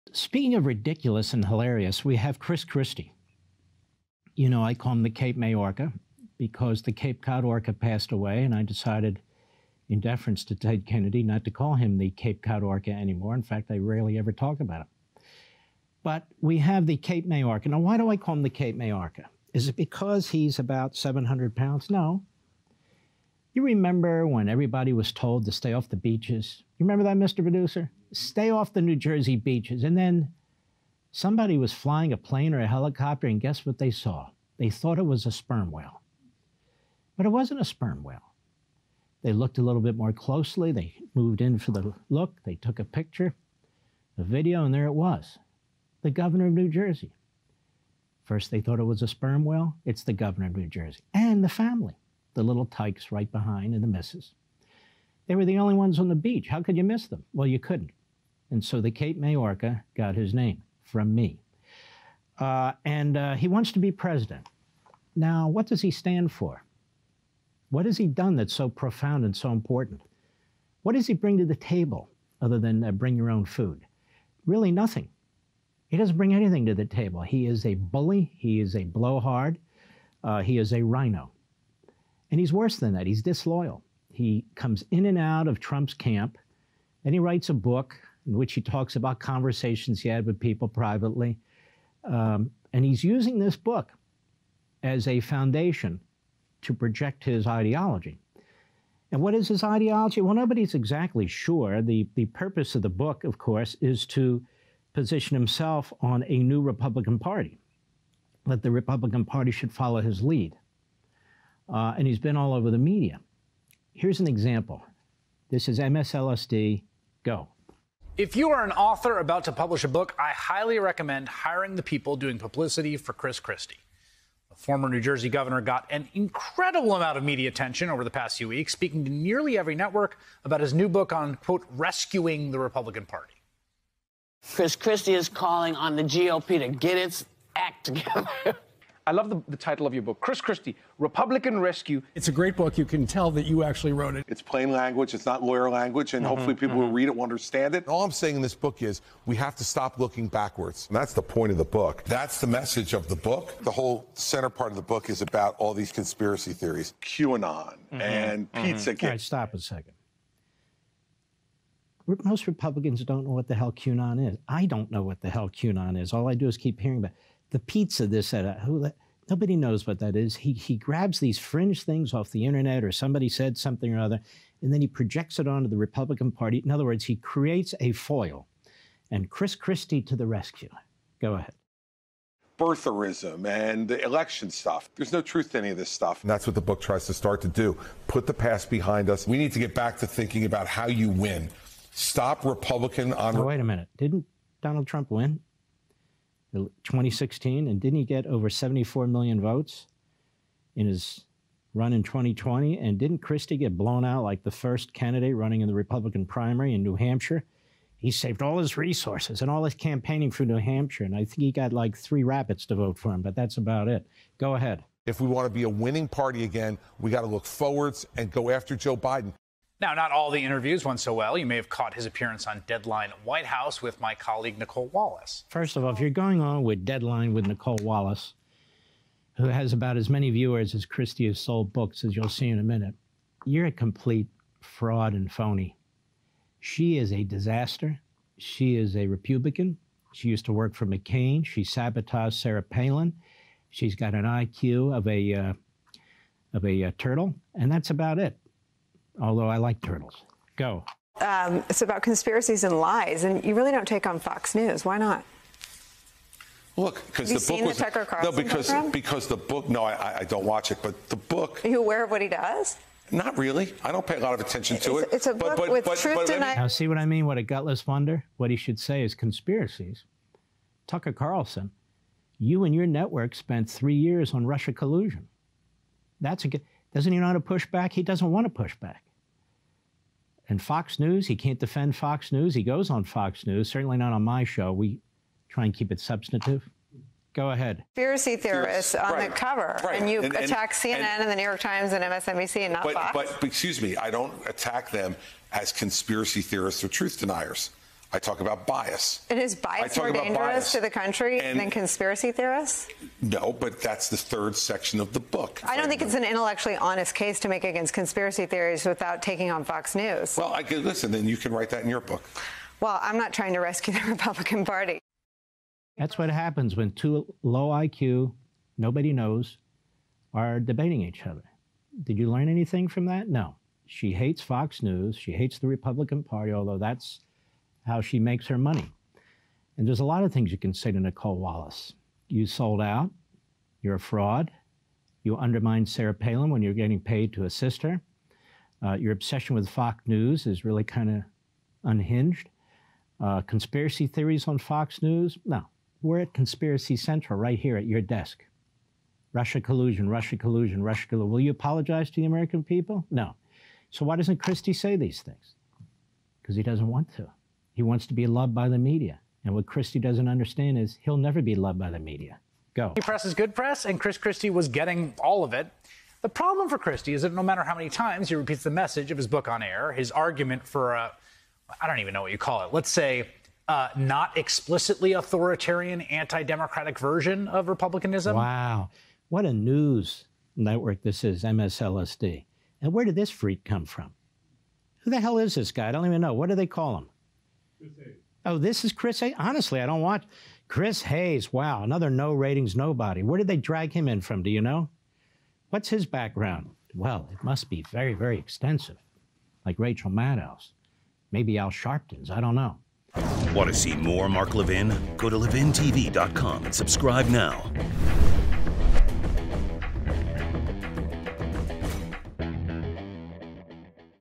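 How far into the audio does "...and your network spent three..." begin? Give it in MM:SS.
04:32.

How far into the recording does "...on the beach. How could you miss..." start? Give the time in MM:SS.
00:55.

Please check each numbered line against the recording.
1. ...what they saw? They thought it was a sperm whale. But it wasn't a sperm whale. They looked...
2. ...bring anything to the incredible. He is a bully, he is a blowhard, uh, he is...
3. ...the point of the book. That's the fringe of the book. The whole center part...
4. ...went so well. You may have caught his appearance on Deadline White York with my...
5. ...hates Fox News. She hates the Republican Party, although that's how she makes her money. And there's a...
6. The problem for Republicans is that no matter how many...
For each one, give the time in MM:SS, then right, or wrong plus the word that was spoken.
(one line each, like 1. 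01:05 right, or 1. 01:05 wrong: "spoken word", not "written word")
1. 00:33 right
2. 01:16 wrong: "table", not "incredible"
3. 02:31 wrong: "message", not "fringe"
4. 03:40 wrong: "House", not "York"
5. 05:24 right
6. 06:06 wrong: "Christie", not "Republicans".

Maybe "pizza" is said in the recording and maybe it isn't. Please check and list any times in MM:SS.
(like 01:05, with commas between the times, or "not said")
02:38, 02:47.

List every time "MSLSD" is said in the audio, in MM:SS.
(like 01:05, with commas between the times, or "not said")
01:55, 06:21.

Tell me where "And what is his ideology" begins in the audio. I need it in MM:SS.
01:39.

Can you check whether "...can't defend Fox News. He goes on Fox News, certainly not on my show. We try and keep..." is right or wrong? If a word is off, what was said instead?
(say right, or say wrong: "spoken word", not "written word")
right.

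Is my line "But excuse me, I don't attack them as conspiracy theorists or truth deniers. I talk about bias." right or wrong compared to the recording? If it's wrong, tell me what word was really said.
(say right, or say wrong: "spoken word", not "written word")
right.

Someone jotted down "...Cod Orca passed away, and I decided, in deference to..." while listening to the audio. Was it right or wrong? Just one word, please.
right.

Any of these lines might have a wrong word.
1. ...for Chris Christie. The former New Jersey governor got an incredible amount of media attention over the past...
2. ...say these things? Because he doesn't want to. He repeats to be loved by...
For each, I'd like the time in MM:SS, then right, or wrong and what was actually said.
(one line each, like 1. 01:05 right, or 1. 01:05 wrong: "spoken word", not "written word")
1. 02:02 right
2. 05:54 wrong: "wants", not "repeats".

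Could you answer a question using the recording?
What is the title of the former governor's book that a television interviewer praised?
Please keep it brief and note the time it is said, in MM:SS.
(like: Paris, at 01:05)
Republican Rescue, at 02:20.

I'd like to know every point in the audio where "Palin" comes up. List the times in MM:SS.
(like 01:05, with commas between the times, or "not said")
04:02, 05:36.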